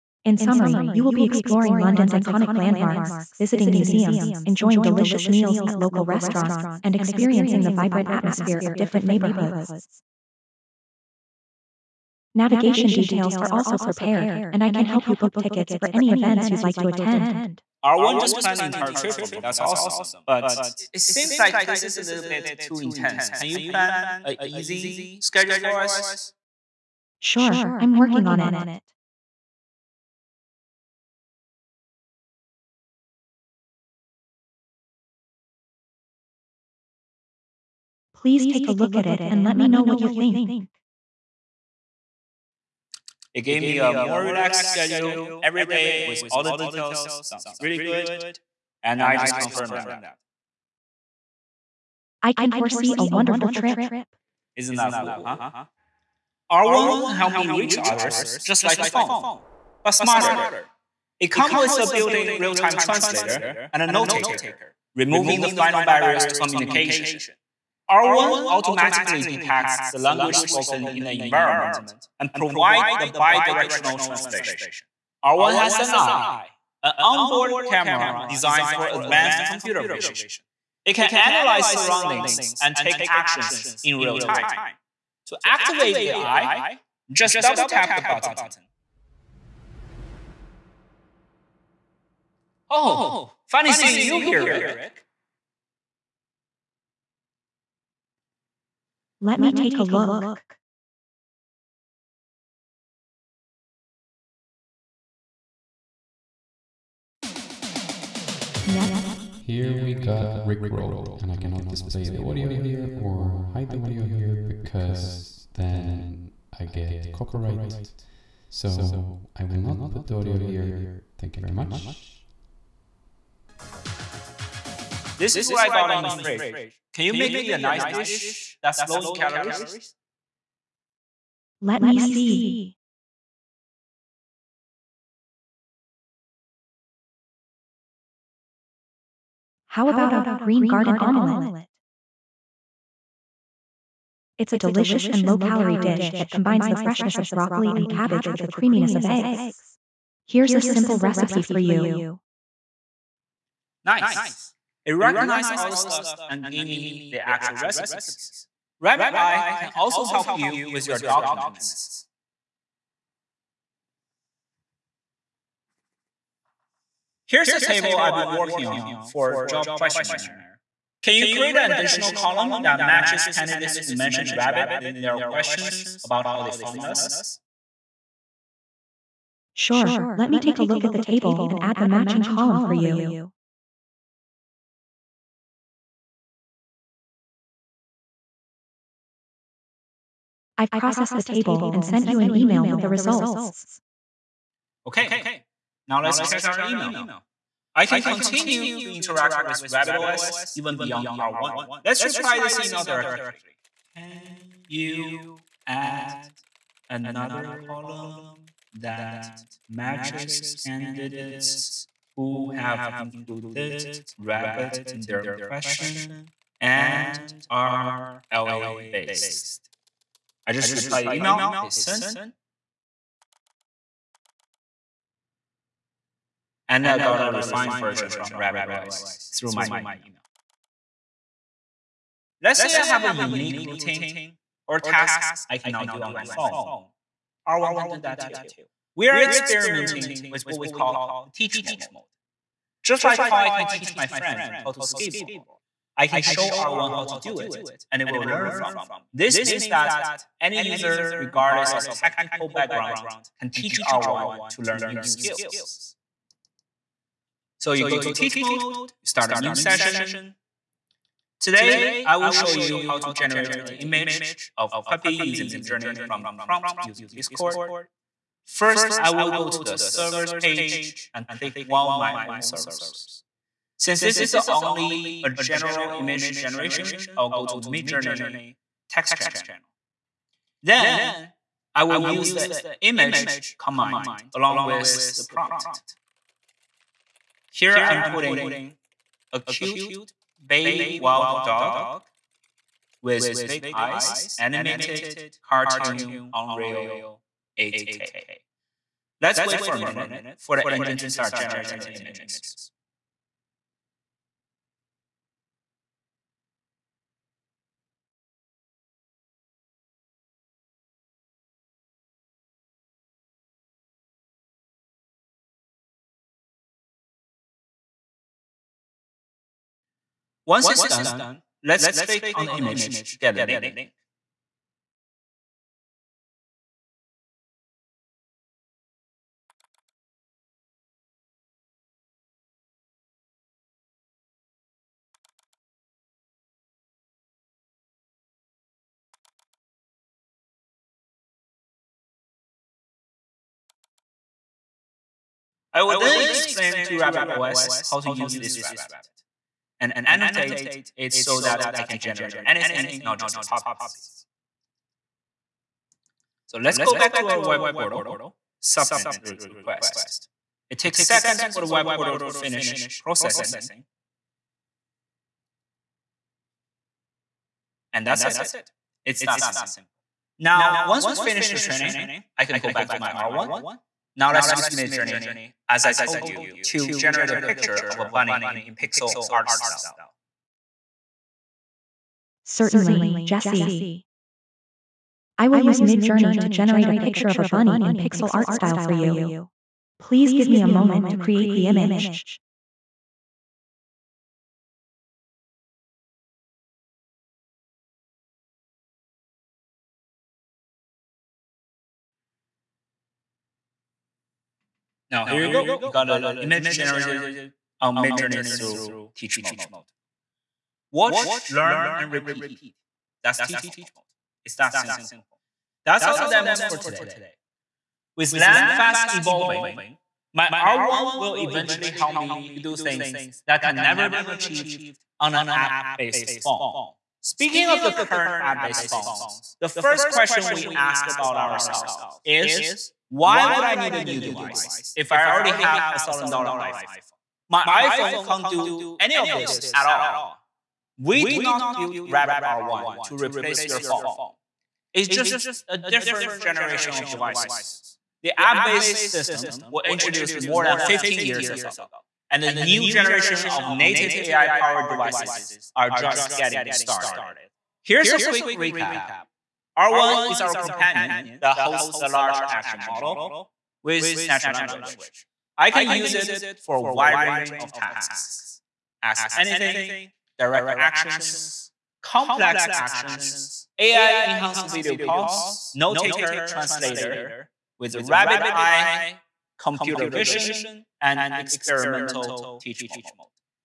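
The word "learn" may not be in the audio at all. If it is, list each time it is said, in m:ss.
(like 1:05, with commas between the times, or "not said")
4:08, 4:14, 6:51.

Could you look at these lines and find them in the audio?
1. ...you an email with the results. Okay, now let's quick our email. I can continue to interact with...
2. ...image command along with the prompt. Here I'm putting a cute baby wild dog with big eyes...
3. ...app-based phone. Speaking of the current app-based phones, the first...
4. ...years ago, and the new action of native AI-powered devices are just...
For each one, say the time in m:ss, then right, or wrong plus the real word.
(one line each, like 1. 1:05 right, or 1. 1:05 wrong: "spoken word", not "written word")
1. 3:12 wrong: "check", not "quick"
2. 4:42 right
3. 7:05 right
4. 7:31 wrong: "generation", not "action".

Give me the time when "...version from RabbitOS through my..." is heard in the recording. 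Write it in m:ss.
3:47.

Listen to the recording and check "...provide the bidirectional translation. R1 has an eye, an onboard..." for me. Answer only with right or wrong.
right.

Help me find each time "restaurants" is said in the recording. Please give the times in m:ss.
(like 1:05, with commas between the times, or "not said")
0:06.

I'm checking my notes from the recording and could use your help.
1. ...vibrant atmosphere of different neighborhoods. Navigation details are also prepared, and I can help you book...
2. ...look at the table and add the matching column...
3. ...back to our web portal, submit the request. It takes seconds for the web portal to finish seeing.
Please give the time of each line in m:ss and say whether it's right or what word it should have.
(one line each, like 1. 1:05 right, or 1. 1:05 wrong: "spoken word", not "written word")
1. 0:07 right
2. 3:00 right
3. 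5:56 wrong: "processing", not "seeing".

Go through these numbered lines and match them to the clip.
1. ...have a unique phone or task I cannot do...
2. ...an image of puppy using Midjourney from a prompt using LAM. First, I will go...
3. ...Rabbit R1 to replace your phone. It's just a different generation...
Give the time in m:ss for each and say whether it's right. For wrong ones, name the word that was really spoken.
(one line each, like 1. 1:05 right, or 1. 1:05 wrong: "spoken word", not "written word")
1. 3:52 wrong: "routine", not "phone"
2. 4:23 wrong: "Discord", not "LAM"
3. 7:22 right.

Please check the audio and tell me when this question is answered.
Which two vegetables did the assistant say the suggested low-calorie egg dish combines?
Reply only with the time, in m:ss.
2:27.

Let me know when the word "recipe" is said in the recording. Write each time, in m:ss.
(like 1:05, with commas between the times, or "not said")
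2:30, 2:37.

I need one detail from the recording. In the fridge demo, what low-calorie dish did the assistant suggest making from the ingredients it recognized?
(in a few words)
green garden omelette.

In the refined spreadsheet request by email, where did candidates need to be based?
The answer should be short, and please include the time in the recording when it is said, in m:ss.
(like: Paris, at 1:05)
LA, at 3:38.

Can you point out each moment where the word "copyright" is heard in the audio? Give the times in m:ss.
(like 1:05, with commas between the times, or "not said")
1:57.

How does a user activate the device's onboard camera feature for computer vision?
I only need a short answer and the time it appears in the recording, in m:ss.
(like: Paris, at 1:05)
double tap the button, at 1:27.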